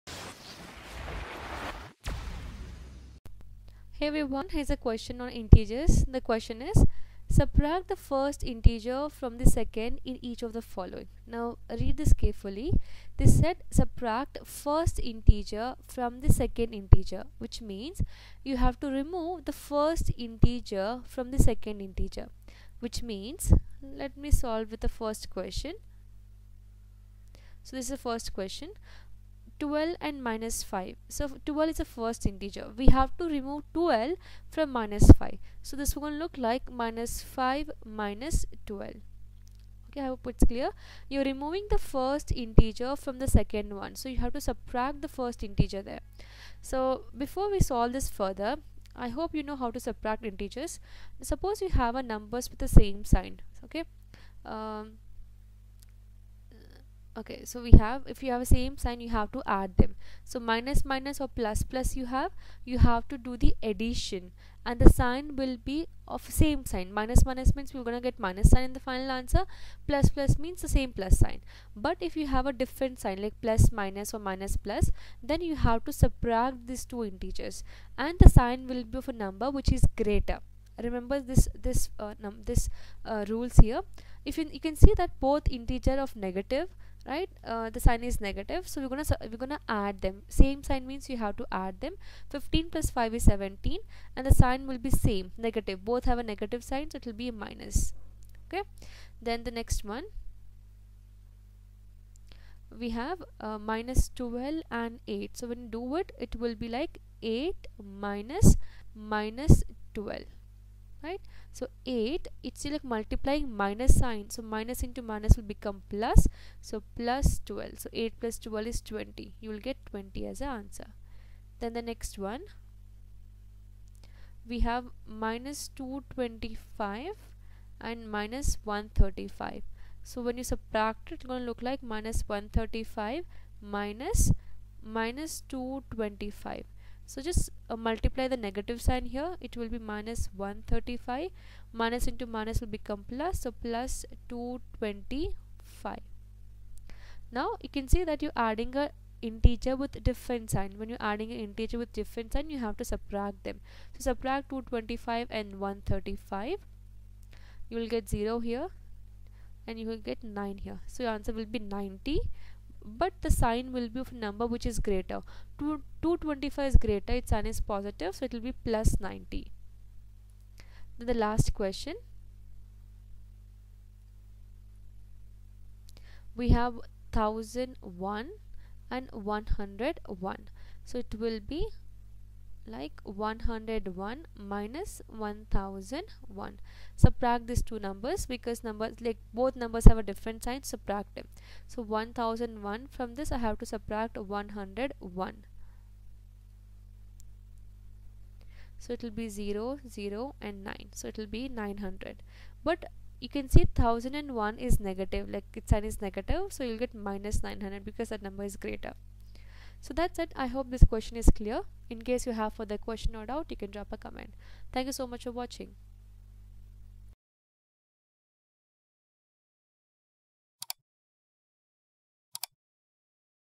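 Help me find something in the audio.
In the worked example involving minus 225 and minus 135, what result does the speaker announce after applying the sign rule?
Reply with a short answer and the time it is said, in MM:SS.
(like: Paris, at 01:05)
plus 90, at 02:48.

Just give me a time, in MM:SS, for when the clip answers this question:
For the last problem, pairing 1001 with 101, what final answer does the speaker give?
03:26.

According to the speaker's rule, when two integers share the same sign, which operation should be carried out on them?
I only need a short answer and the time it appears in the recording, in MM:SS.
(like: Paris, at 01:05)
addition, at 01:03.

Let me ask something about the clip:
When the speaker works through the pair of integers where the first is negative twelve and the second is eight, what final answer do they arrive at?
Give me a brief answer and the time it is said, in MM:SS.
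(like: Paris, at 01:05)
20, at 01:59.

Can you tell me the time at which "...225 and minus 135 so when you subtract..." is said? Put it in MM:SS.
02:05.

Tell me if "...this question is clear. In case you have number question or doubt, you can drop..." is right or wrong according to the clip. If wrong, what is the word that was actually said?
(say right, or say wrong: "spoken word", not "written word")
wrong: "further", not "number".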